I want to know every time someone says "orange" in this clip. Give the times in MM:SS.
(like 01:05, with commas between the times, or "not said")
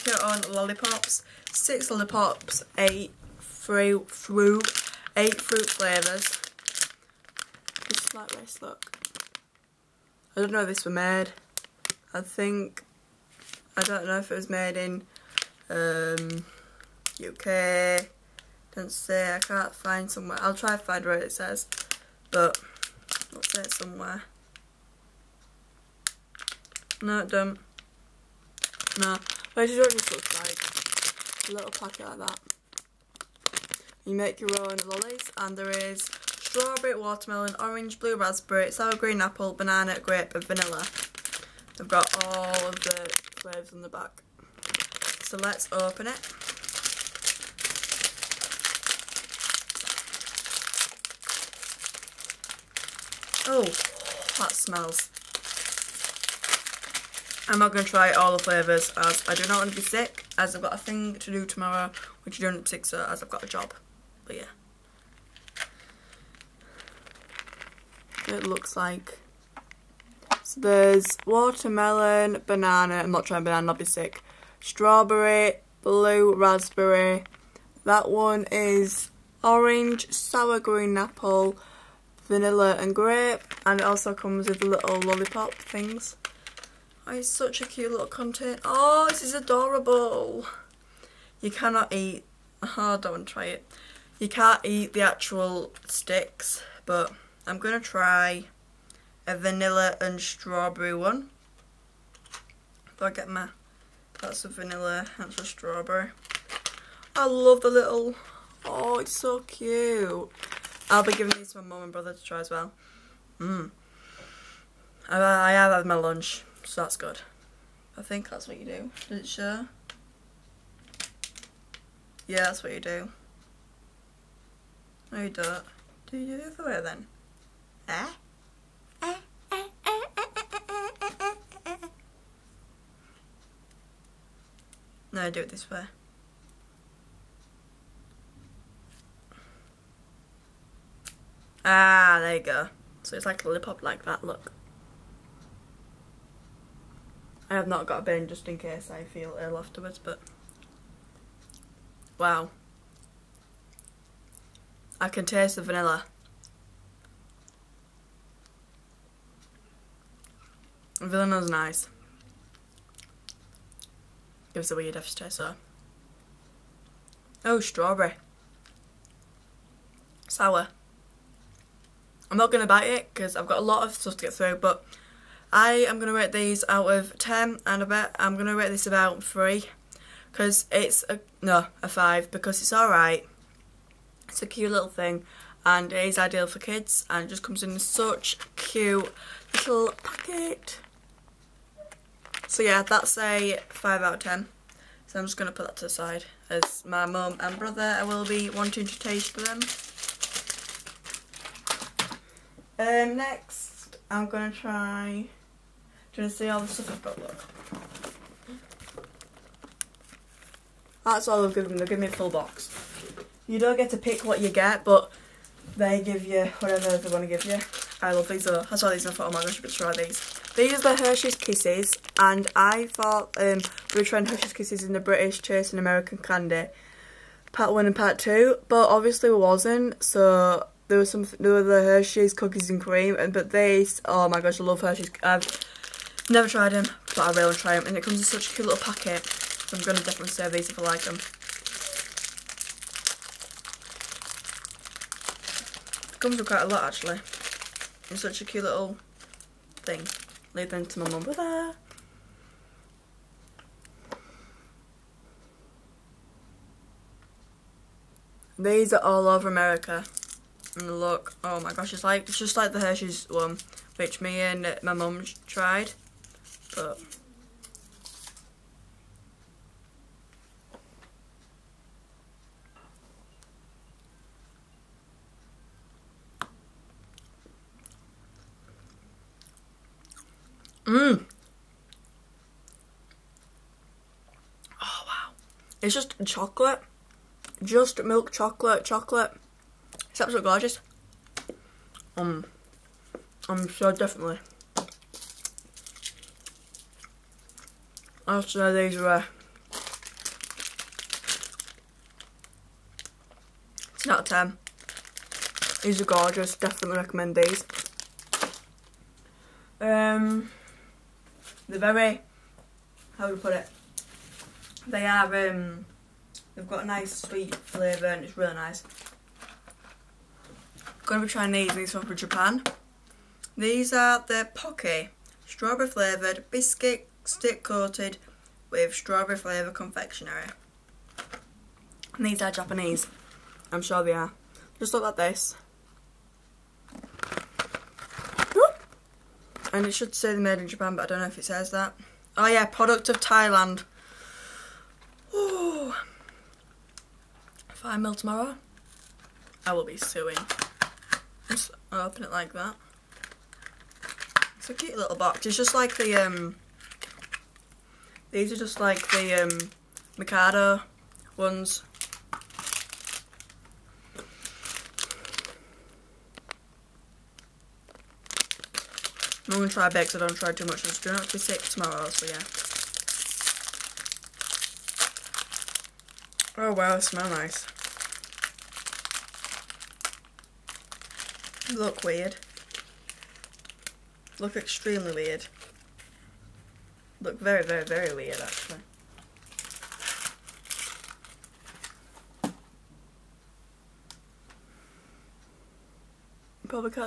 00:37, 01:19.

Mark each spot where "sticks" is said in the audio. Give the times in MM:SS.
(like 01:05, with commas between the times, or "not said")
01:35, 05:27.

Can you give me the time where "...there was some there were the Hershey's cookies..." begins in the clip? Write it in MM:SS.
03:50.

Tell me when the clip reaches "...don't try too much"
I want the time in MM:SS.
06:10.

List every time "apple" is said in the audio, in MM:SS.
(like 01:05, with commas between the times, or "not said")
00:39, 01:20.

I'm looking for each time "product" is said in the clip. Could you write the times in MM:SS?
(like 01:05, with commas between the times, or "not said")
05:42.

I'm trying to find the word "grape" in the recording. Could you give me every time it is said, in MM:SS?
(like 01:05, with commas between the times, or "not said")
00:39, 01:22.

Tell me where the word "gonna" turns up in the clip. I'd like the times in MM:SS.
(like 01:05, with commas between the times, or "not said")
03:59, 05:21.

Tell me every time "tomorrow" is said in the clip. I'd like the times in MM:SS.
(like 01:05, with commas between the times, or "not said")
01:01, 05:48, 06:11.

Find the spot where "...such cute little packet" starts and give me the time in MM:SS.
03:07.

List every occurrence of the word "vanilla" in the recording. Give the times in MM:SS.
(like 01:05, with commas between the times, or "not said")
00:40, 01:22, 01:39, 01:44, 02:35.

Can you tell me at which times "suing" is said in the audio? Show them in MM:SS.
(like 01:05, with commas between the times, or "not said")
05:49.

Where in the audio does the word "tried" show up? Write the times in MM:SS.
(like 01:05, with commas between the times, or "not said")
03:56, 04:25.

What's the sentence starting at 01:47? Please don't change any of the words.
I love the little, oh it's so cute.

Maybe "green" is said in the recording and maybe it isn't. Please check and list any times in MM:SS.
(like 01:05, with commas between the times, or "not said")
00:38, 01:20.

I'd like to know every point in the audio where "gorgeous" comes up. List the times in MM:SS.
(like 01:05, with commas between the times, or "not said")
04:50, 05:06.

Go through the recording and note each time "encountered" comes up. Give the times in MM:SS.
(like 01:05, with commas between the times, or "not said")
not said.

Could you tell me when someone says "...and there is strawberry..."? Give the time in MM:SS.
00:35.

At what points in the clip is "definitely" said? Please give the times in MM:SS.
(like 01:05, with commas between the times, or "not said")
03:59, 04:53, 05:06.